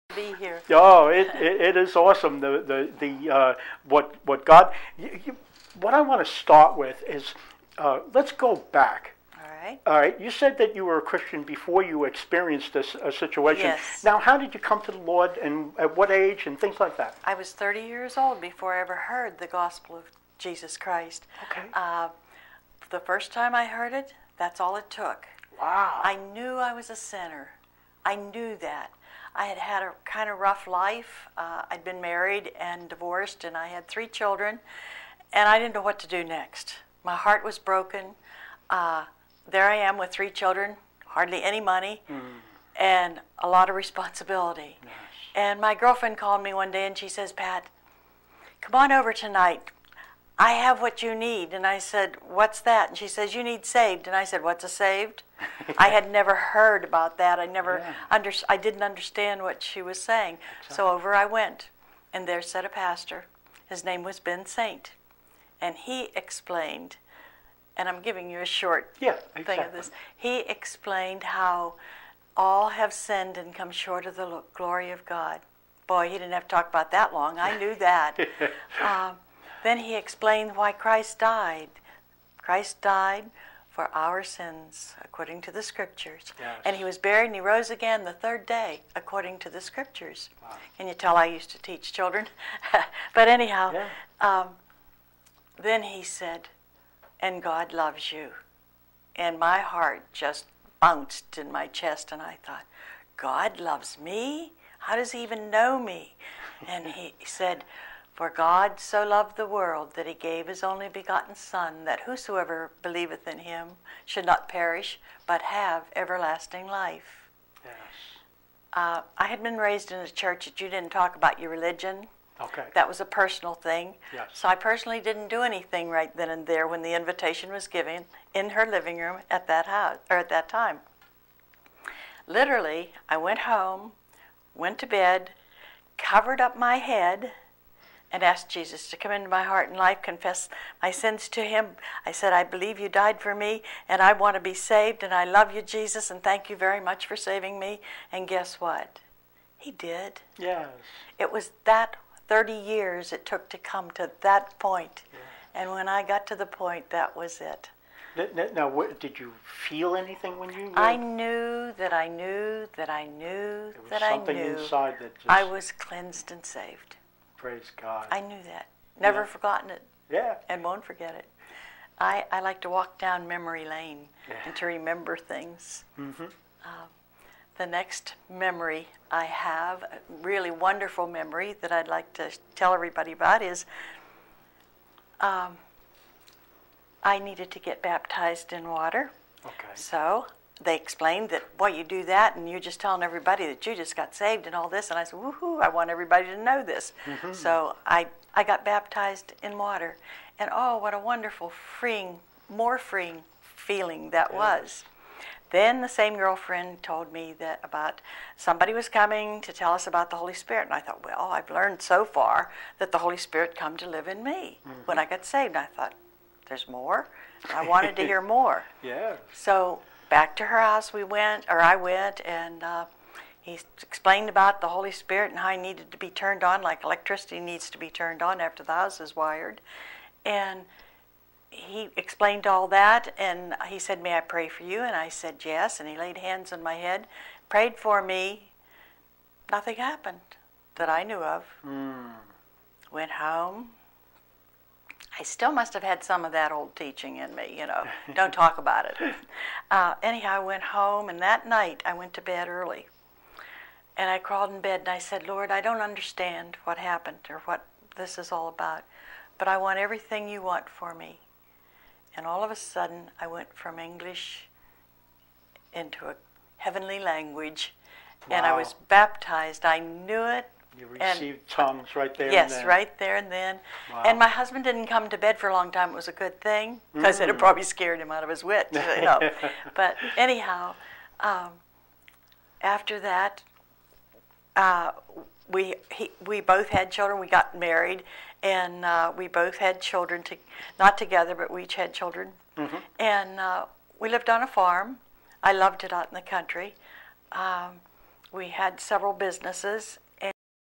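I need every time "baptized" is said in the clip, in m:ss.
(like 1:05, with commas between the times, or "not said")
3:07, 3:18, 4:28.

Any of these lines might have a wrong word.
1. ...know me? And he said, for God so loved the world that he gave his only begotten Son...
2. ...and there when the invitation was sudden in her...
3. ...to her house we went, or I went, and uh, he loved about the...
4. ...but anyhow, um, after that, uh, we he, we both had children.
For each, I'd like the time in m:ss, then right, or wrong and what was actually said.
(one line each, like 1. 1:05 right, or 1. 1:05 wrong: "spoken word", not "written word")
1. 1:45 right
2. 2:06 wrong: "given", not "sudden"
3. 3:40 wrong: "explained", not "loved"
4. 4:39 right.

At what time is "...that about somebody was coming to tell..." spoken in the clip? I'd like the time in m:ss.
3:27.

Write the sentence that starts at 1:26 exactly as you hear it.
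And he was buried and he rose again the third day according to the scriptures.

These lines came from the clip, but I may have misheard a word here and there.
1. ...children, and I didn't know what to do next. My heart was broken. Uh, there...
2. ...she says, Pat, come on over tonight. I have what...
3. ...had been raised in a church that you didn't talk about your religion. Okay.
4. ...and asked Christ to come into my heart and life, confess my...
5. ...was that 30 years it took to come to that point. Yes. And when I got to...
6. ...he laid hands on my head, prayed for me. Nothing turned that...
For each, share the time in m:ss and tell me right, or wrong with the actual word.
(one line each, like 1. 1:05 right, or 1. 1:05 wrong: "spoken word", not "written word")
1. 0:34 right
2. 0:46 right
3. 1:59 right
4. 2:18 wrong: "Jesus", not "Christ"
5. 2:31 right
6. 3:55 wrong: "happened", not "turned".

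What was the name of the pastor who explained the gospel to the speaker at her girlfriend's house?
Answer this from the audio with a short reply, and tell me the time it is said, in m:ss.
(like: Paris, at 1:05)
Ben Saint, at 1:04.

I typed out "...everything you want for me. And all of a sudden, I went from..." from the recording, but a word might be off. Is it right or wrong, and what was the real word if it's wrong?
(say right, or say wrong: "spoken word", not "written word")
right.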